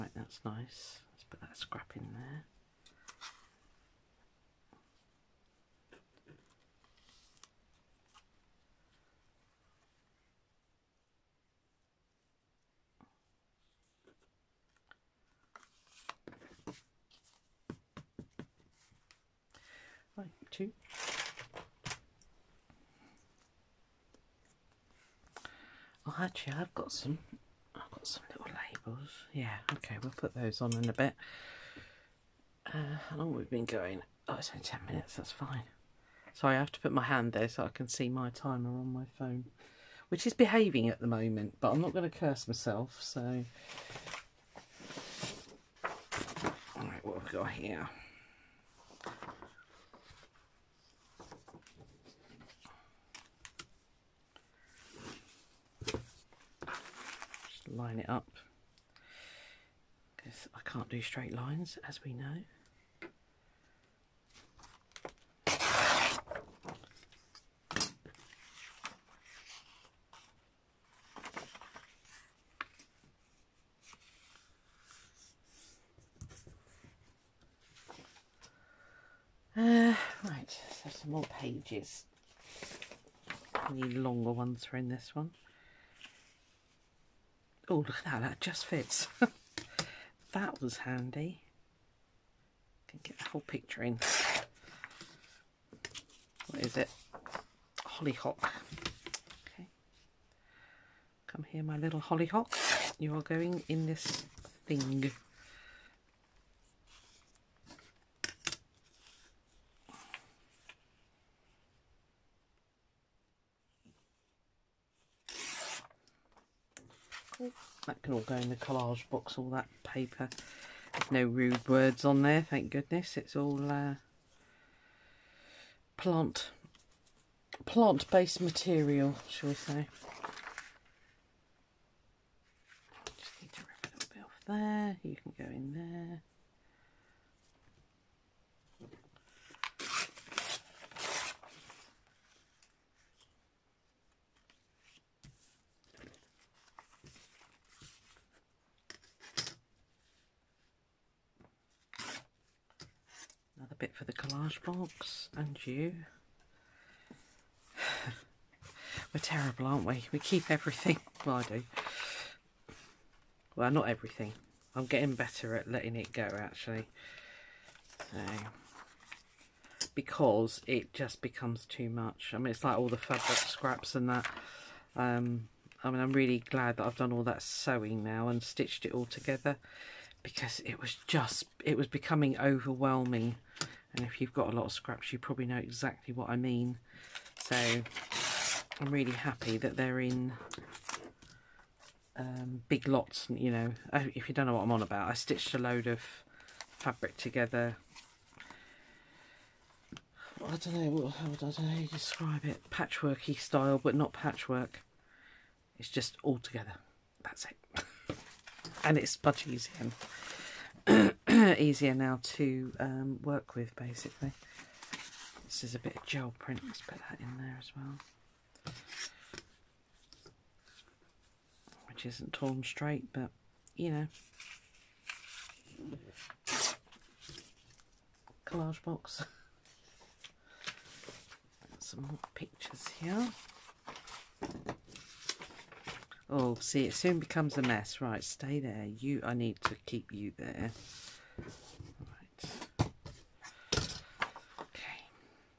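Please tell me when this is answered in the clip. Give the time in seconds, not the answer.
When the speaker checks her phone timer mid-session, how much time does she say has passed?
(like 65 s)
34 s.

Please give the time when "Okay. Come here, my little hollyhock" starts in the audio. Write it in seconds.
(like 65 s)
99 s.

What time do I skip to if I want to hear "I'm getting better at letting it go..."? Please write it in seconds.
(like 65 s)
164 s.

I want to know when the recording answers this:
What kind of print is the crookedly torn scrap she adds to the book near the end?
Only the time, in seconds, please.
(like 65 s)
216 s.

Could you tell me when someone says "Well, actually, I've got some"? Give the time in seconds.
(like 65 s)
26 s.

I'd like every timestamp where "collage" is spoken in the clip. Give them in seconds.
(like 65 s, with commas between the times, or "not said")
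118 s, 154 s, 228 s.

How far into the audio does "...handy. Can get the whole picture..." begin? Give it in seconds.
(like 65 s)
90 s.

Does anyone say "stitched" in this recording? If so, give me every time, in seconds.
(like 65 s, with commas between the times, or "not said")
178 s, 195 s.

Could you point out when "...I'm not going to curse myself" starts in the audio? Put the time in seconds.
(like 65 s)
41 s.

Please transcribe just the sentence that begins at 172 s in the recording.
I mean, it's like all the fabric scraps and that.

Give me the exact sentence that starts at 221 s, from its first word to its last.
Which isn't torn straight, but you know.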